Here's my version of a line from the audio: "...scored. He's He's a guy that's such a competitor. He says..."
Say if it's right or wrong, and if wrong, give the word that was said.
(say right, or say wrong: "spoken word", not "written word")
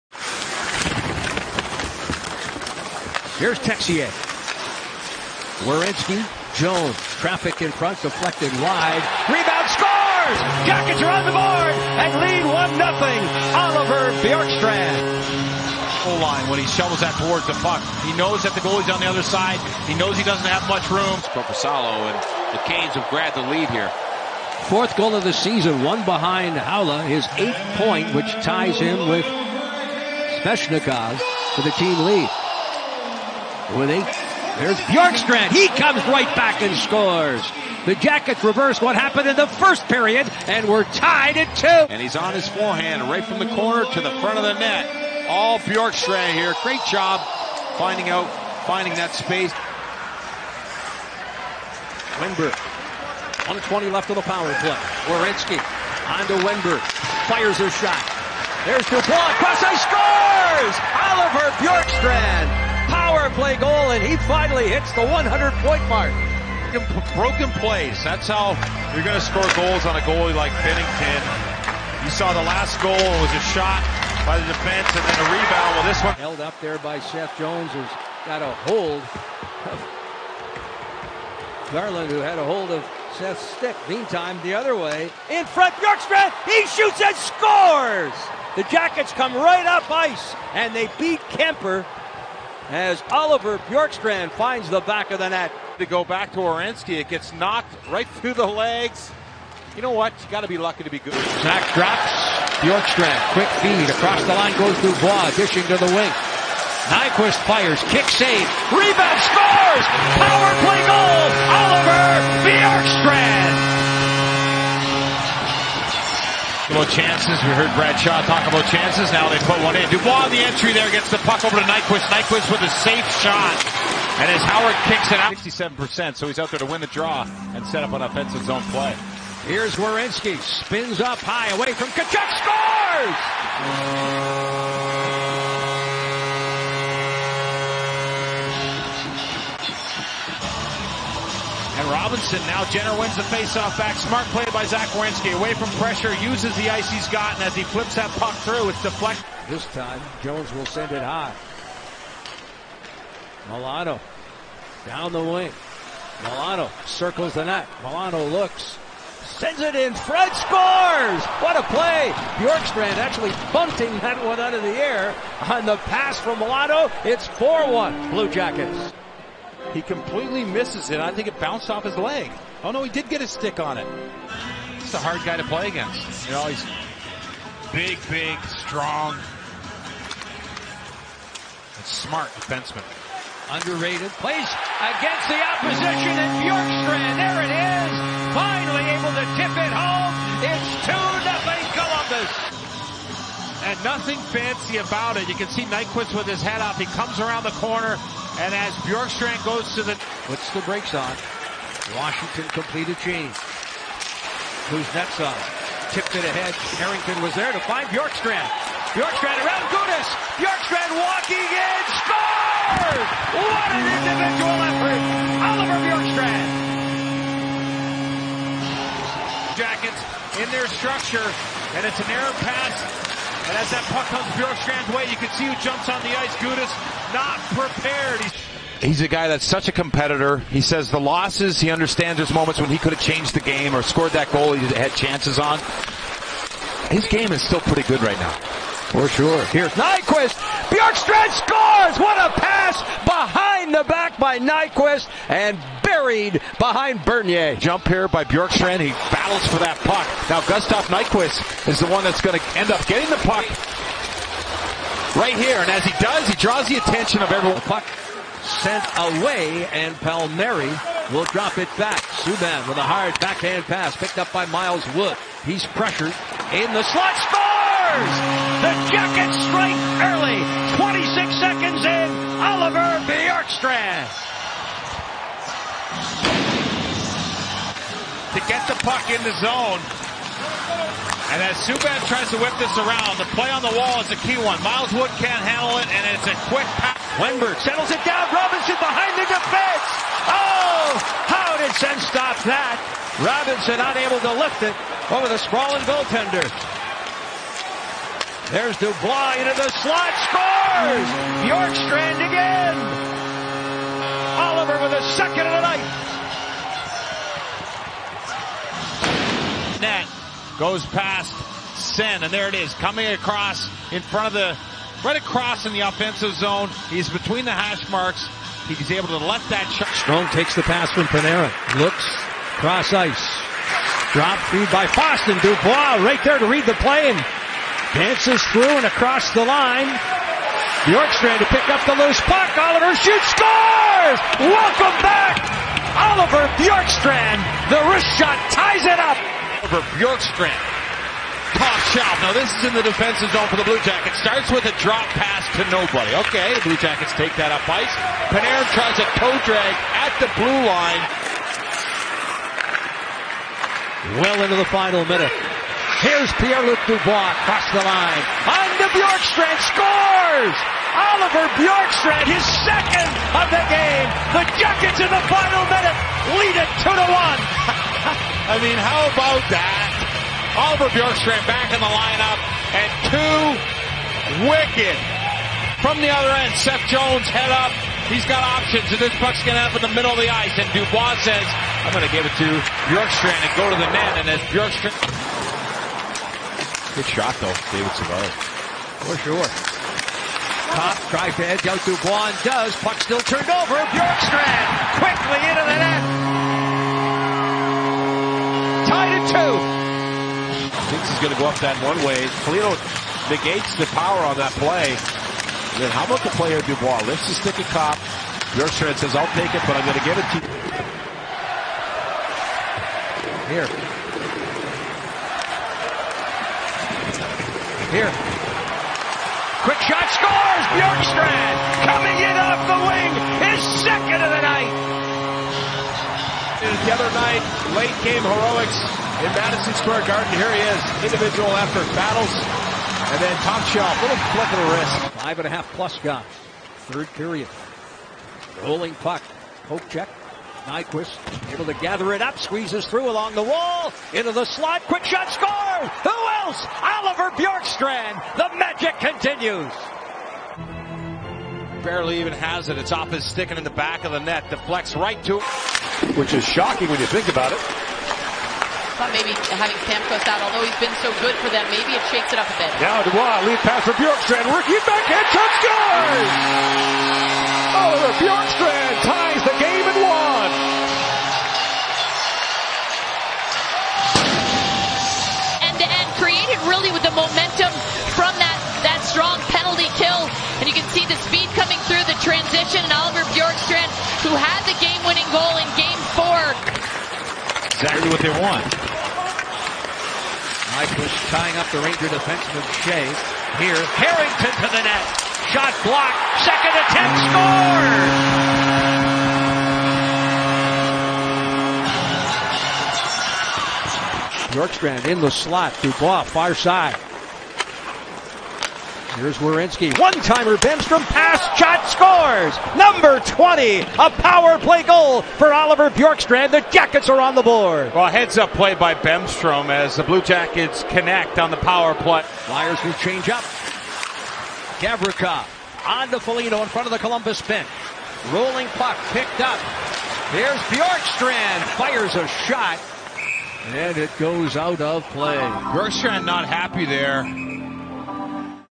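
wrong: "prepared", not "scored".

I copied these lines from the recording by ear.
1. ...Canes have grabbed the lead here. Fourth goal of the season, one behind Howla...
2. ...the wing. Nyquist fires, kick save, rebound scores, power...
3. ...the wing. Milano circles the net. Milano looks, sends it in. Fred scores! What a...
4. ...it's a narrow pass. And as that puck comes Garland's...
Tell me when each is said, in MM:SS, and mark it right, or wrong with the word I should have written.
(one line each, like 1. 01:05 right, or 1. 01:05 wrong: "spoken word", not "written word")
1. 00:22 right
2. 01:45 right
3. 02:35 right
4. 03:41 wrong: "Bjorkstrand", not "Garland".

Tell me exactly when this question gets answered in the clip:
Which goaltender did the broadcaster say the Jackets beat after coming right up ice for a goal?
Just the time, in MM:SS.
01:31.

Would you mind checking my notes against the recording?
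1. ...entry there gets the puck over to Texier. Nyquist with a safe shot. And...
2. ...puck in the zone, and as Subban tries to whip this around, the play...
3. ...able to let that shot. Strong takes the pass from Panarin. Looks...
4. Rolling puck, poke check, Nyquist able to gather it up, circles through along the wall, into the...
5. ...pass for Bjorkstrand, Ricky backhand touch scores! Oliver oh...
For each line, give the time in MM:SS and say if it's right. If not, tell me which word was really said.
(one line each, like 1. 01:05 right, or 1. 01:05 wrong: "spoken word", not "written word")
1. 02:00 wrong: "Nyquist", not "Texier"
2. 04:38 right
3. 05:18 right
4. 07:18 wrong: "squeezes", not "circles"
5. 07:43 right.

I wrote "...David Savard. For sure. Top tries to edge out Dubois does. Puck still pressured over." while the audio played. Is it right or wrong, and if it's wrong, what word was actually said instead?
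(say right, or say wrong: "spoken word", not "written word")
wrong: "turned", not "pressured".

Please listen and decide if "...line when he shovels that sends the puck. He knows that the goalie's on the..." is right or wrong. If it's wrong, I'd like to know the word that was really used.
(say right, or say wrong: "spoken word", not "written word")
wrong: "towards", not "sends".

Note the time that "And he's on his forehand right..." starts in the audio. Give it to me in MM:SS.
00:41.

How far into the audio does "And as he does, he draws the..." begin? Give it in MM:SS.
04:15.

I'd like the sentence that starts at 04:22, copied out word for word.
Subban with a hard backhand pass picked up by Miles Wood.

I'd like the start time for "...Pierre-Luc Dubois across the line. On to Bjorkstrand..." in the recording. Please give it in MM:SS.
05:56.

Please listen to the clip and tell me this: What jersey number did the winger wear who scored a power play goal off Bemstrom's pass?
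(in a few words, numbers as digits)
20.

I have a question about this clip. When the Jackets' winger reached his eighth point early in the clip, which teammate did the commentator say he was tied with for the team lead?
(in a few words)
Svechnikov.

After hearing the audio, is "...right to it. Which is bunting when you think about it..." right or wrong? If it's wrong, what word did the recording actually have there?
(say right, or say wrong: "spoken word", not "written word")
wrong: "shocking", not "bunting".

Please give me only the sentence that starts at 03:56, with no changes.
His game is still pretty good right now.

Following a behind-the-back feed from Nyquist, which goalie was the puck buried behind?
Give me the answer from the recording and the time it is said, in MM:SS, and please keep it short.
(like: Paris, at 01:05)
Bernier, at 04:07.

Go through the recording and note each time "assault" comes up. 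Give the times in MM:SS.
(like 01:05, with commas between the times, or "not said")
not said.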